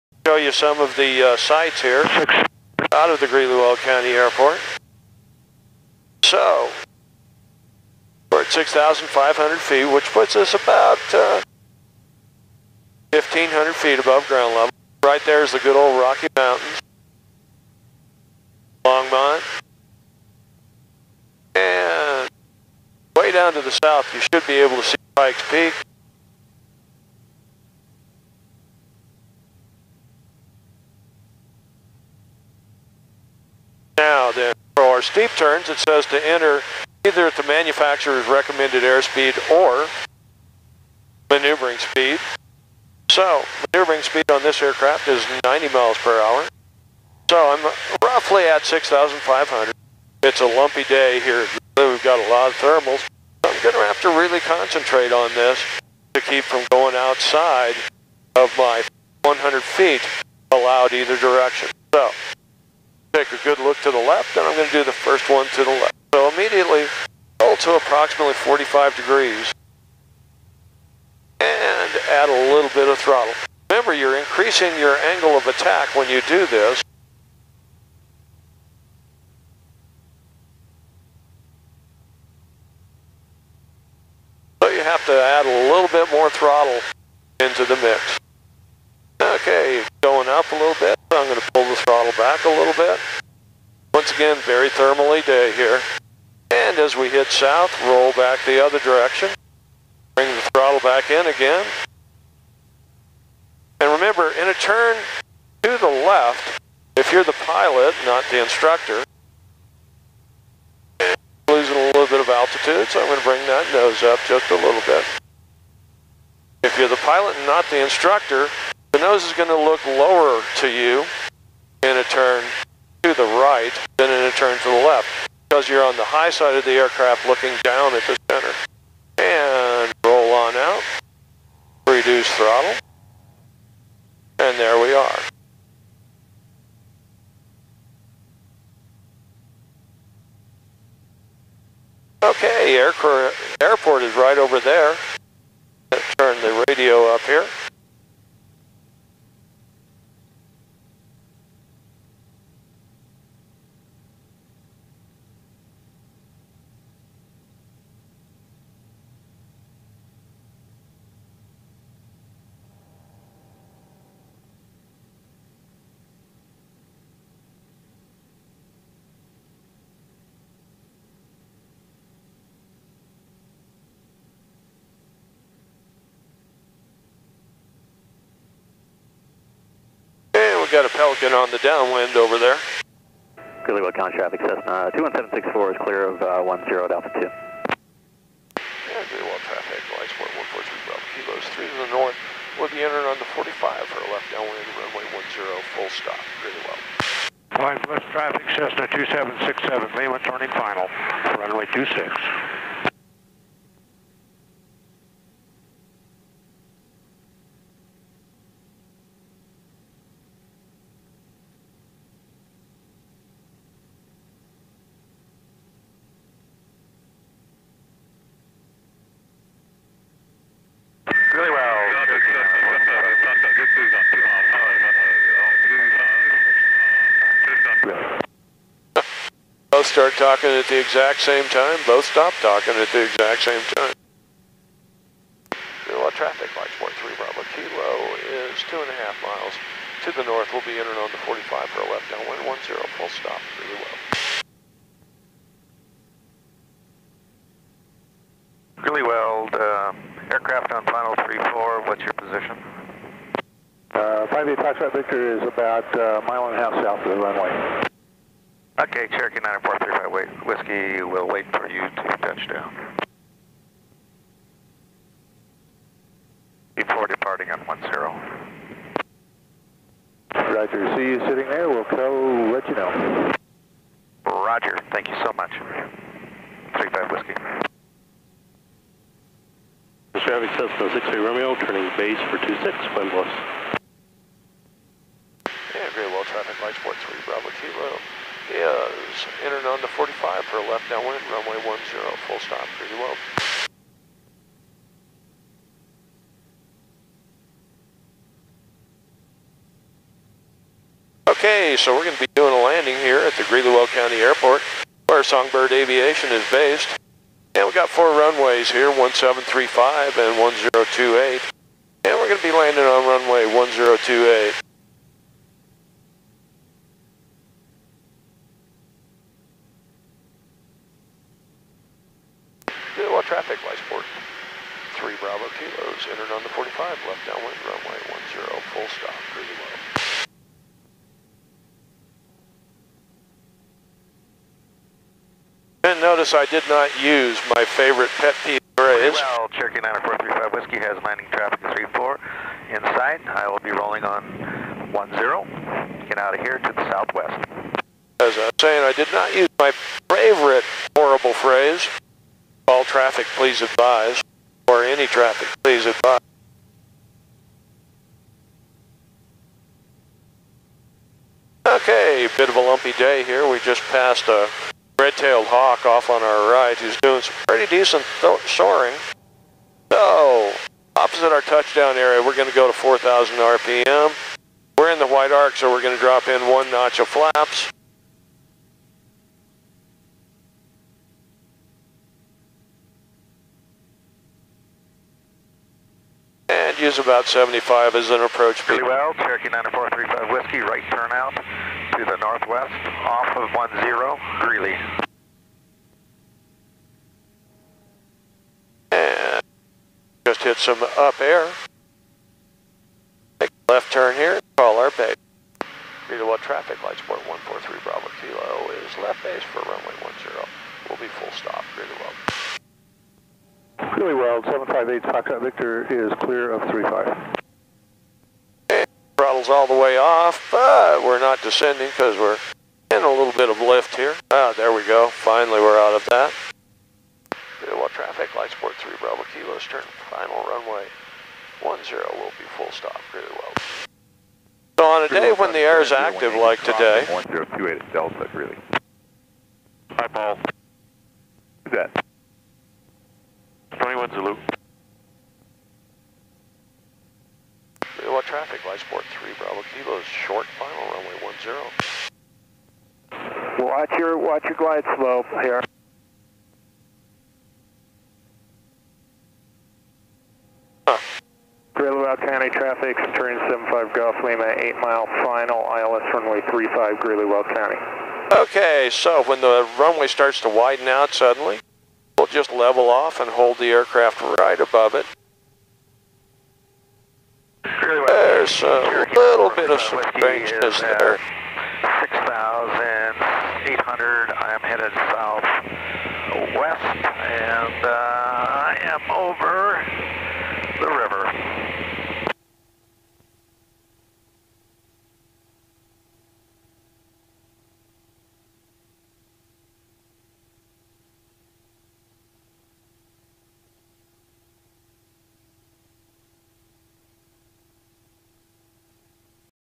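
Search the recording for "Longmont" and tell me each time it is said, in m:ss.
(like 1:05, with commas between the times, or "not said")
0:18.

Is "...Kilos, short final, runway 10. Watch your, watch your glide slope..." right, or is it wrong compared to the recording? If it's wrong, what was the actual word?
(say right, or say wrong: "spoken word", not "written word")
right.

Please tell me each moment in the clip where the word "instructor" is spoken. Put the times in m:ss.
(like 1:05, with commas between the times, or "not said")
1:48, 1:57.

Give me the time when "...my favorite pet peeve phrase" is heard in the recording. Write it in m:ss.
5:37.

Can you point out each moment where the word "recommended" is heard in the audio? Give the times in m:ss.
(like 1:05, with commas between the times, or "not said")
0:38.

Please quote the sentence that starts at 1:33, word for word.
Once again, very thermally day here.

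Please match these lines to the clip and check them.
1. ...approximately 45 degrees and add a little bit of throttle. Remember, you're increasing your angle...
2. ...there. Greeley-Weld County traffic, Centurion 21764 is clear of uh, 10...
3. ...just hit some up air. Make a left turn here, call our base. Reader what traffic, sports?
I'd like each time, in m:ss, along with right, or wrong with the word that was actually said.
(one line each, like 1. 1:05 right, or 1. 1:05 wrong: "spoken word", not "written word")
1. 1:07 right
2. 3:02 wrong: "Cessna", not "Centurion"
3. 6:40 wrong: "lights", not "sports".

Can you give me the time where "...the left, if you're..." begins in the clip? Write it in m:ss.
1:45.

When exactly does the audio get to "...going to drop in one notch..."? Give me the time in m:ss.
6:15.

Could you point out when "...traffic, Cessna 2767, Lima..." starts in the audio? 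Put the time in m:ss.
3:18.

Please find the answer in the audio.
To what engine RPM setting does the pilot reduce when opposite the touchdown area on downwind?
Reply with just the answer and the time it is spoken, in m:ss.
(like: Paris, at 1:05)
4,000 RPM, at 6:12.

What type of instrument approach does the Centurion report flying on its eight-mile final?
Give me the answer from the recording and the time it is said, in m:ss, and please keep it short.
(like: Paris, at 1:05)
ILS, at 7:45.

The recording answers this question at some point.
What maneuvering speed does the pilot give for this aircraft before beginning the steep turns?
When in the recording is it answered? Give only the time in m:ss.
0:45.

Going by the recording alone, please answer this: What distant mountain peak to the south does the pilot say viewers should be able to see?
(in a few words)
Pikes Peak.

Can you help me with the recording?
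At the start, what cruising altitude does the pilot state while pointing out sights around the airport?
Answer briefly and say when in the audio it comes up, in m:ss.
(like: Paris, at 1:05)
6,500 feet, at 0:08.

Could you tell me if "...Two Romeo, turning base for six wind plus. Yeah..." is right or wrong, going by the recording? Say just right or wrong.
wrong.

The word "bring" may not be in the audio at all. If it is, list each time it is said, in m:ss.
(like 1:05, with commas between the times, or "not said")
1:40, 1:53.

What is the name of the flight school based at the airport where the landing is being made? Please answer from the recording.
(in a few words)
Songbird Aviation.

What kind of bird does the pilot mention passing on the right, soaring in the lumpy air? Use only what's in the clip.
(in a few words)
red-tailed hawk.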